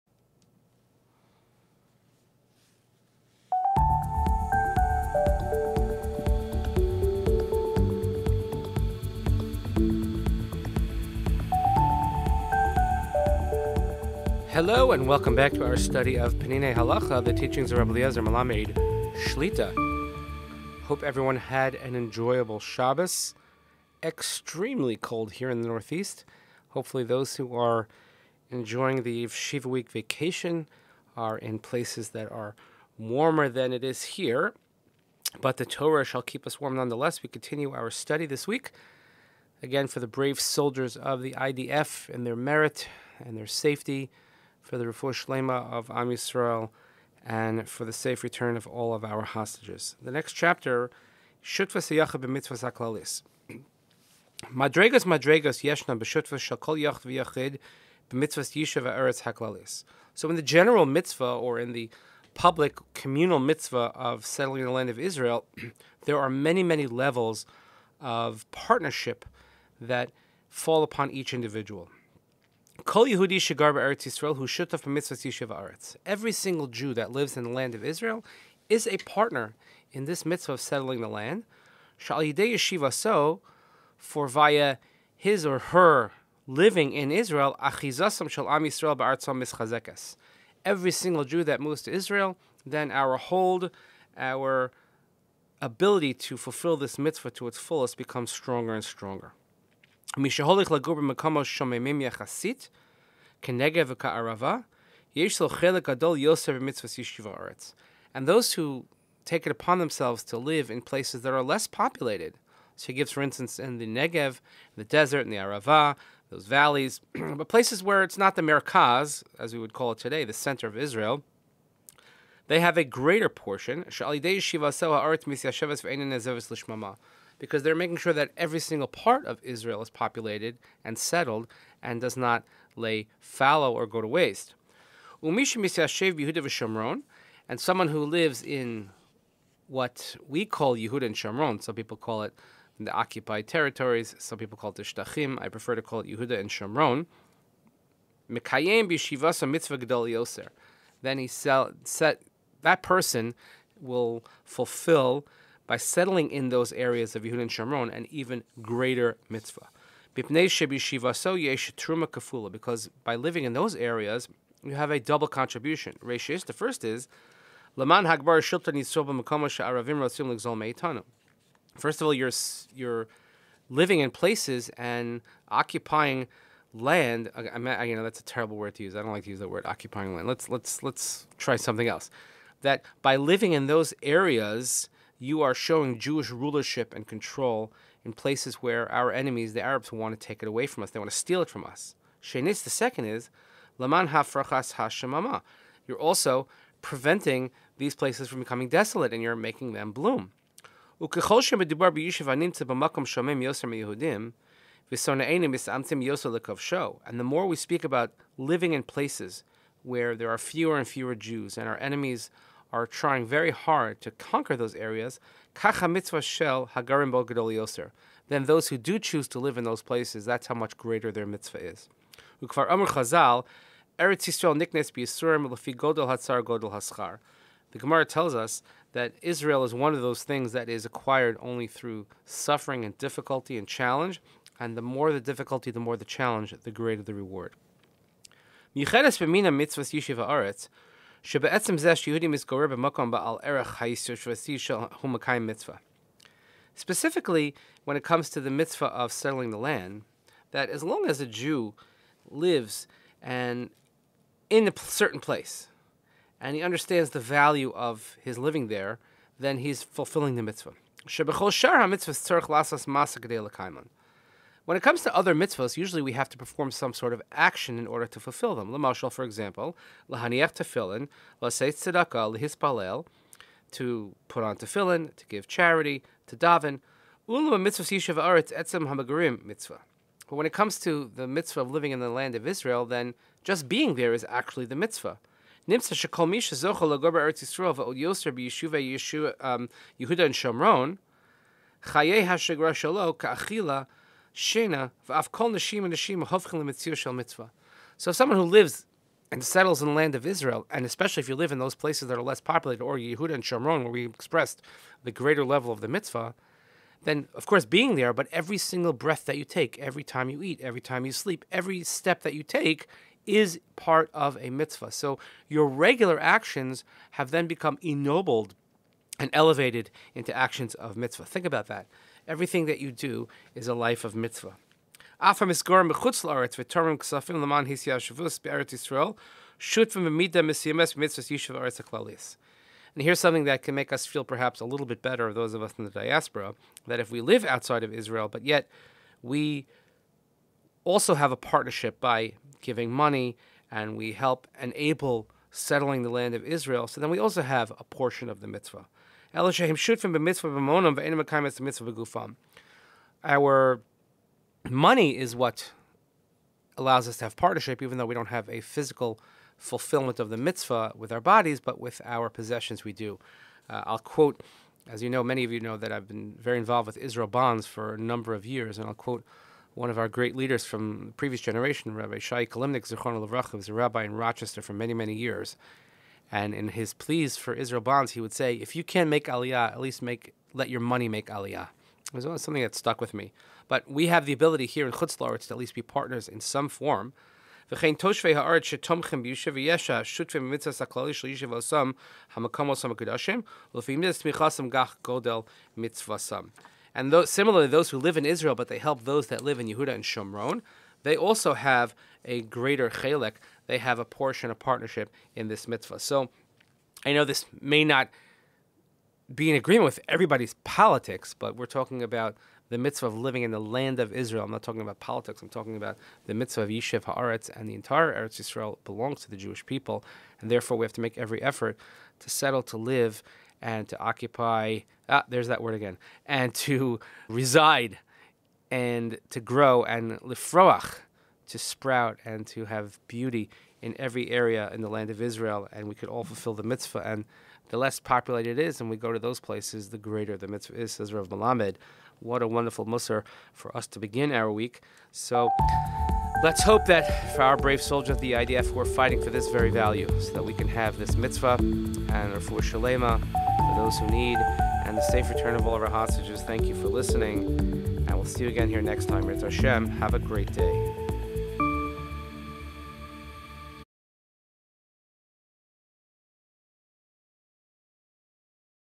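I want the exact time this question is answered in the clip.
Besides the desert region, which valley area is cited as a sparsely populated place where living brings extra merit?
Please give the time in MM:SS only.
01:55.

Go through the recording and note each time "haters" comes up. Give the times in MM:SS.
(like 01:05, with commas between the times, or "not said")
not said.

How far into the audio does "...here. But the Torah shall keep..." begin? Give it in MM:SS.
00:34.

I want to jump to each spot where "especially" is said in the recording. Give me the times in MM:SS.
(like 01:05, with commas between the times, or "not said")
05:00.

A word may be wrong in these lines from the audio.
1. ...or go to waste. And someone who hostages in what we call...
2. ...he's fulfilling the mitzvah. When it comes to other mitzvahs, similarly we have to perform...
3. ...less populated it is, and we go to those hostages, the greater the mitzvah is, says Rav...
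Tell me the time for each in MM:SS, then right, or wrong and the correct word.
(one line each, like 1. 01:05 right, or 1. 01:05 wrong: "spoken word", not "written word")
1. 02:13 wrong: "lives", not "hostages"
2. 04:19 wrong: "usually", not "similarly"
3. 07:17 wrong: "places", not "hostages".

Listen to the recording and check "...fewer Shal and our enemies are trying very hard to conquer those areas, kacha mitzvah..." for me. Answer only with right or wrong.
wrong.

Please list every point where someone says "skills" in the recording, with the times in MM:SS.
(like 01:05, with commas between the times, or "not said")
not said.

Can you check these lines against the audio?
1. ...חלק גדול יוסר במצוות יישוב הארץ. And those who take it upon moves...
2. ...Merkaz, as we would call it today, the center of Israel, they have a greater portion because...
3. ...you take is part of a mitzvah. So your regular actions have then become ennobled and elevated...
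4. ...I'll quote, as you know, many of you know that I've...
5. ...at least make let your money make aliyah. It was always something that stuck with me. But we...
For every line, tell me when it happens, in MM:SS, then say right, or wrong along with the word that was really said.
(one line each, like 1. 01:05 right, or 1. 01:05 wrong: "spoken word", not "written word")
1. 01:45 wrong: "themselves", not "moves"
2. 01:58 right
3. 05:12 right
4. 06:03 right
5. 06:19 right.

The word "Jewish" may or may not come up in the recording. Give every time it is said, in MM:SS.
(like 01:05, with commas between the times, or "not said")
03:05, 06:59.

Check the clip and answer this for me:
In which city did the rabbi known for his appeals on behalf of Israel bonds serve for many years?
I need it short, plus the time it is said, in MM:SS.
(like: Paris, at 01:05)
Rochester, at 06:14.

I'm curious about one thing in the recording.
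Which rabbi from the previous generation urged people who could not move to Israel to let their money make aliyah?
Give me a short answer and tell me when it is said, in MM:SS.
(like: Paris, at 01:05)
Rabbi Shai Kalimnik, at 06:11.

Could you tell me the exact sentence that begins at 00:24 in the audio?
Extremely cold here in the Northeast.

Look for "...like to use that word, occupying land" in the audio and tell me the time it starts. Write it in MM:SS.
02:59.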